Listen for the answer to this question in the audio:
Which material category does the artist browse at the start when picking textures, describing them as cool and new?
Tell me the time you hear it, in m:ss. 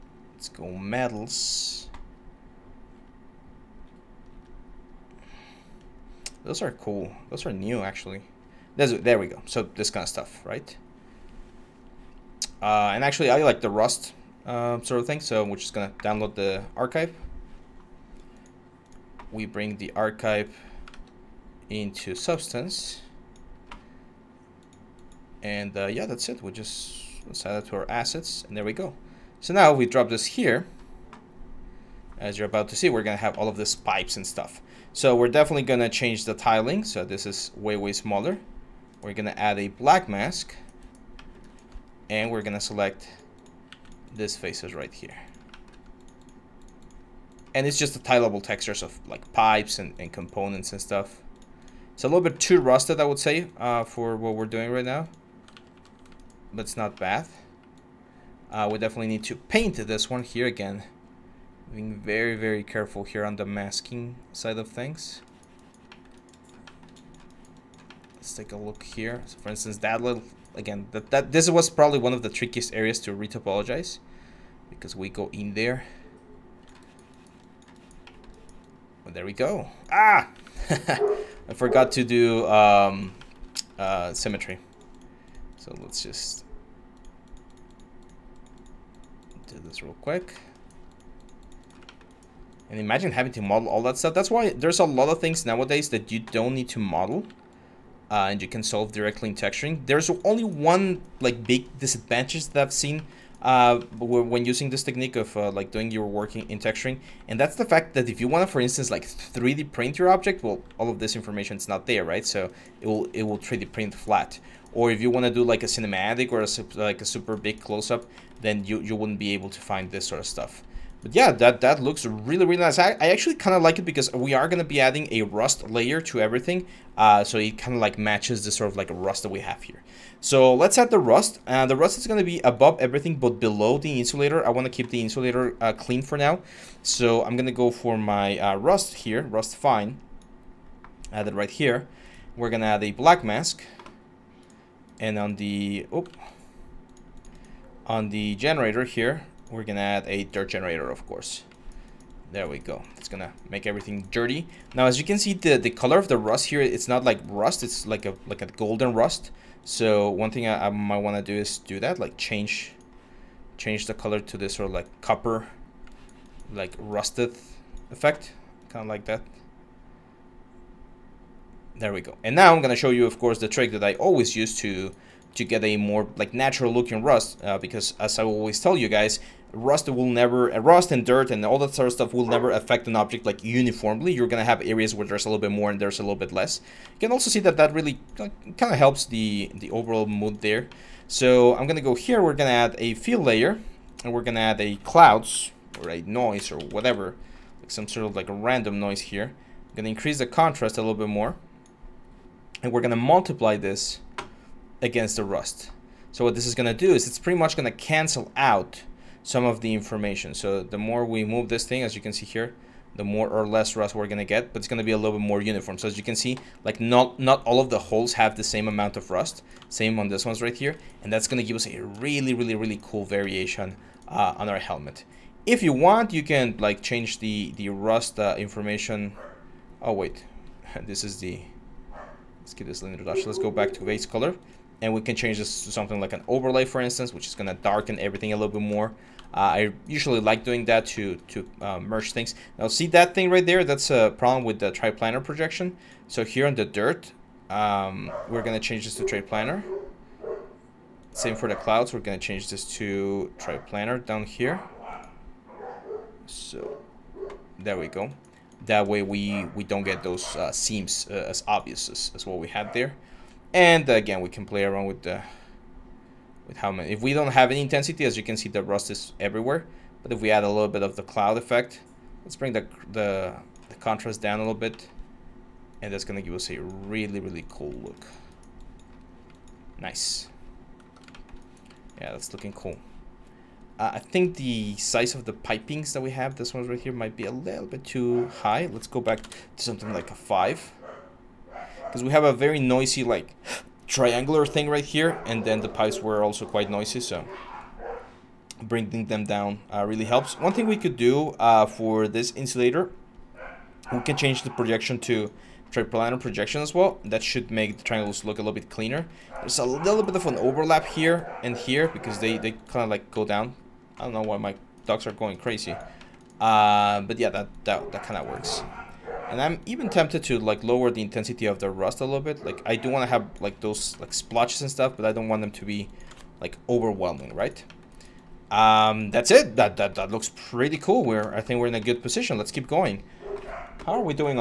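0:00.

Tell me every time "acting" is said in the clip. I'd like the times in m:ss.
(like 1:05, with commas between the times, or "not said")
not said.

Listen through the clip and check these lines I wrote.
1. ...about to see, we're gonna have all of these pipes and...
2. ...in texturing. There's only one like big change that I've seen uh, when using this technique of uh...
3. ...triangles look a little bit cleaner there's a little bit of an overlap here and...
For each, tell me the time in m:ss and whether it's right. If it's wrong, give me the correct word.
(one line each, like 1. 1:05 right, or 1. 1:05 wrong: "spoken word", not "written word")
1. 0:32 right
2. 1:39 wrong: "disadvantage", not "change"
3. 5:07 right.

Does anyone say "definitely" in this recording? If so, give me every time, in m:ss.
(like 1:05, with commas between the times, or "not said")
0:35, 0:58.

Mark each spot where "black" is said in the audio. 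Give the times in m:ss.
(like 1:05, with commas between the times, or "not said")
0:39, 2:22.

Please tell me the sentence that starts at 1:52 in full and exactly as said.
So it will it will 3D print flat.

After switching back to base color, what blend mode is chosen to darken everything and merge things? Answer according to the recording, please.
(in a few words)
Overlay.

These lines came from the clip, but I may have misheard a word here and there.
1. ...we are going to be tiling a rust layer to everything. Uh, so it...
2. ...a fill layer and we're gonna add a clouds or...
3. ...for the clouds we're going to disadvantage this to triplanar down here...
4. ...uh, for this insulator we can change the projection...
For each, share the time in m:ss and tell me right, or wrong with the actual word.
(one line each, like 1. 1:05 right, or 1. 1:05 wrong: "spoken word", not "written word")
1. 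2:04 wrong: "adding", not "tiling"
2. 3:12 right
3. 4:11 wrong: "change", not "disadvantage"
4. 5:01 right.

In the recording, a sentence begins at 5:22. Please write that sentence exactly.
Like I do want to have like those like splotches and stuff, but I don't want them to be like overwhelming, right?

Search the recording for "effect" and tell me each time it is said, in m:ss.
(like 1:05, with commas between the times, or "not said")
2:47, 4:31.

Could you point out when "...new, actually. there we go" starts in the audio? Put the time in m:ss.
0:07.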